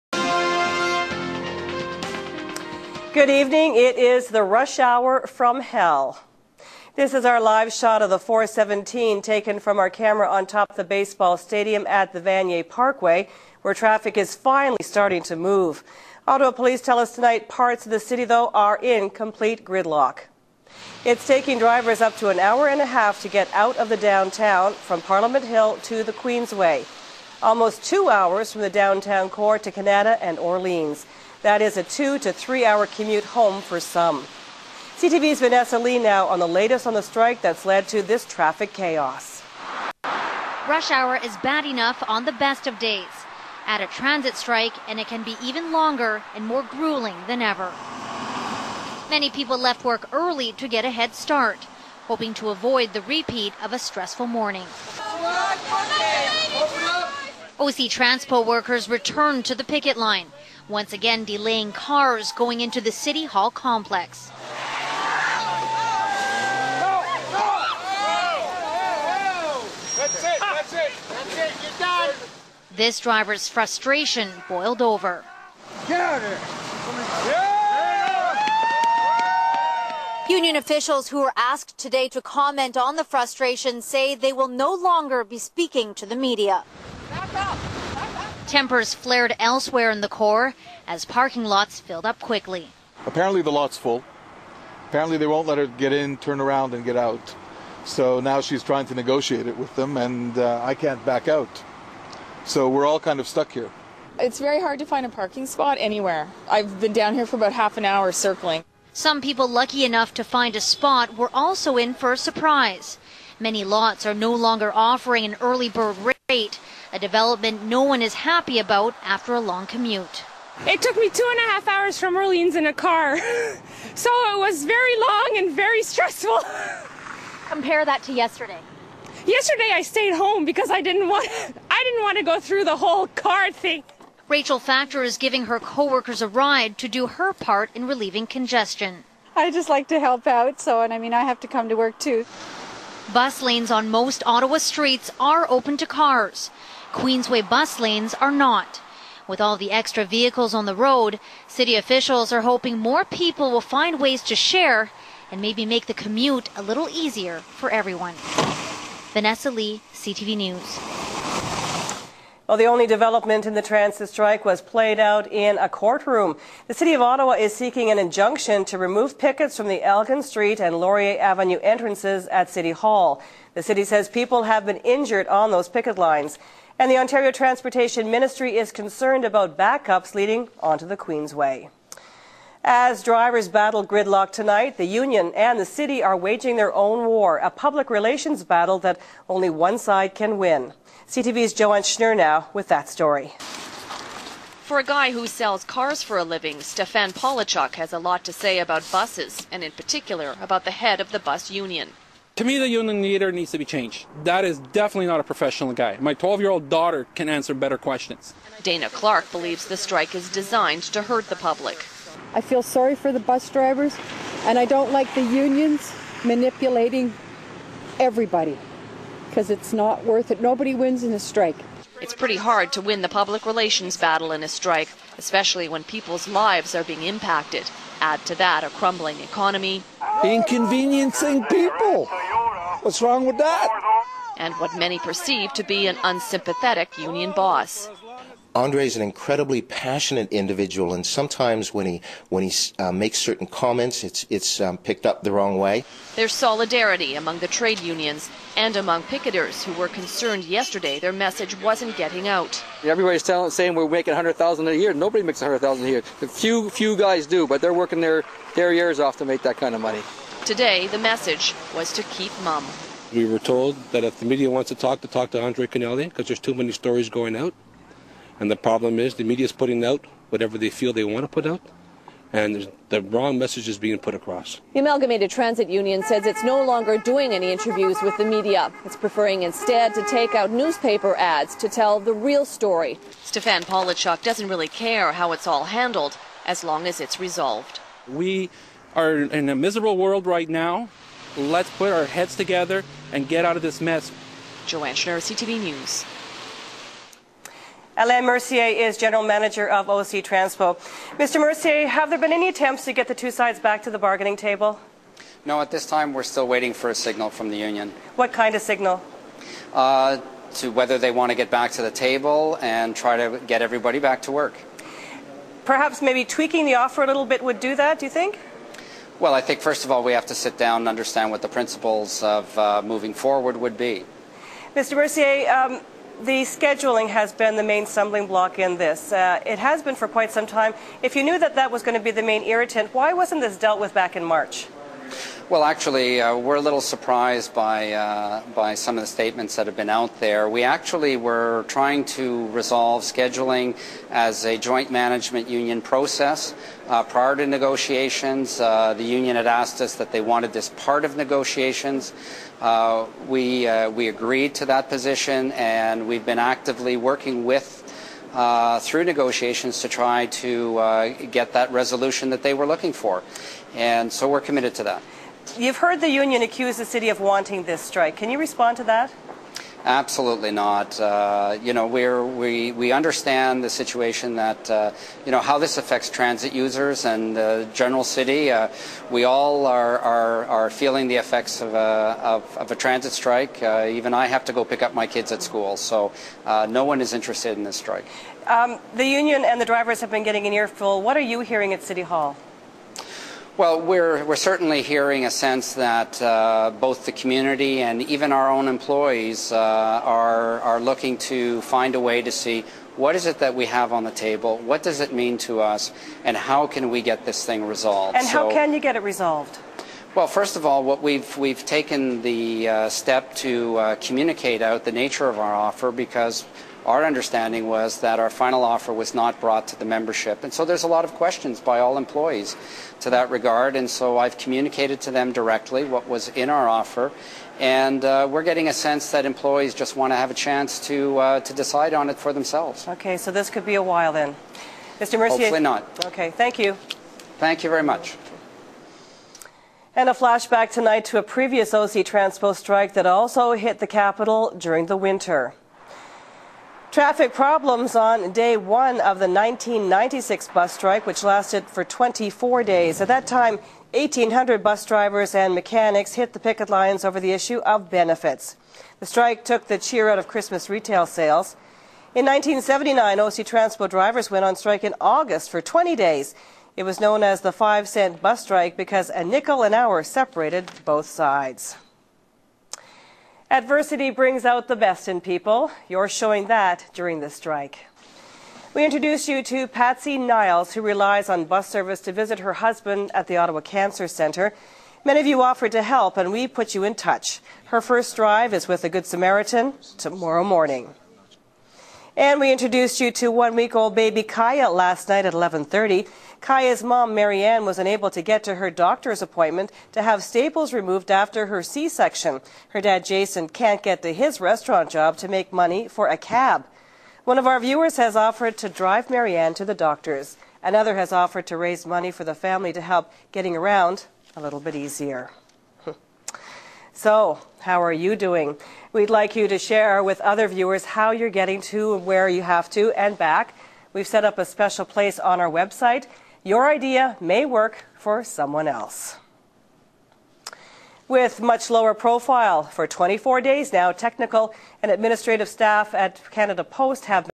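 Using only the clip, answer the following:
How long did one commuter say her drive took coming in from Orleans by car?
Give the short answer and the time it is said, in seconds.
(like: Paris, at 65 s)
2.5 hours, at 121 s.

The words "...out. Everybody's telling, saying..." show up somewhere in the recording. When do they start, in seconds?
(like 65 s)
252 s.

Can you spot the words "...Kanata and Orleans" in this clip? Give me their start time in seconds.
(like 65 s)
29 s.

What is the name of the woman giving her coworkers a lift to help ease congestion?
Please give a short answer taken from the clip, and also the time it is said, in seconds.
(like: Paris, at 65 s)
Rachel Factor, at 134 s.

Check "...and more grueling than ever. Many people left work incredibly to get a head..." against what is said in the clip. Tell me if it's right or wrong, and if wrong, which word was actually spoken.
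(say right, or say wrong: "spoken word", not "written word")
wrong: "early", not "incredibly".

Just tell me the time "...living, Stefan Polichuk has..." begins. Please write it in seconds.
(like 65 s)
196 s.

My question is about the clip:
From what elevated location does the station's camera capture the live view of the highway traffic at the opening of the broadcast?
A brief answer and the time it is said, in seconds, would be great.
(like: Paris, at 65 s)
baseball stadium, at 10 s.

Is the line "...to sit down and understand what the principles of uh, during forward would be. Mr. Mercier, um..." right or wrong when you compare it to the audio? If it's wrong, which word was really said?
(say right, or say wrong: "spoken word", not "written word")
wrong: "moving", not "during".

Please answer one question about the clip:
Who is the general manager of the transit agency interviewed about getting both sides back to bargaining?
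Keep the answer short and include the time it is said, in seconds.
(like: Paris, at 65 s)
Alain Mercier, at 297 s.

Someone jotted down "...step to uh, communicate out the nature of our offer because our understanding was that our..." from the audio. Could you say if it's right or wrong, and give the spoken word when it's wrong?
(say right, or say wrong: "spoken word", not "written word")
right.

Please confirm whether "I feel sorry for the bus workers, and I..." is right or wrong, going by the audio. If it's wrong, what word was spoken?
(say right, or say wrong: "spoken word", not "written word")
wrong: "drivers", not "workers".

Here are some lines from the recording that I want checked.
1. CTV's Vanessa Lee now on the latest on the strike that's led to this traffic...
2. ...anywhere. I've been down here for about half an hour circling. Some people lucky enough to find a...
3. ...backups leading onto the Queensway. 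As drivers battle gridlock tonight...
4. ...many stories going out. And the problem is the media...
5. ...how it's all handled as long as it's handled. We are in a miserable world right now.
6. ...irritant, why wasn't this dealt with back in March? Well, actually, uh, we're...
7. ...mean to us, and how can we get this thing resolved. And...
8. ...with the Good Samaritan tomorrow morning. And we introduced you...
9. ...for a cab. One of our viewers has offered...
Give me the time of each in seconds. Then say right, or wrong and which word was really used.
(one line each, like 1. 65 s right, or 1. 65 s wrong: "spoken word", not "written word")
1. 34 s right
2. 105 s right
3. 179 s right
4. 266 s right
5. 285 s wrong: "resolved", not "handled"
6. 332 s right
7. 405 s right
8. 488 s right
9. 505 s right.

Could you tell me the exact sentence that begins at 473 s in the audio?
Adversity brings out the best in people.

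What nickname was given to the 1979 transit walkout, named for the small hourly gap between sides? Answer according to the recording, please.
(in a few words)
five cent bus strike.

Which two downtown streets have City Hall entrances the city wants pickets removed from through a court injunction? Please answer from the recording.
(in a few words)
Elgin Street and Laurier Avenue.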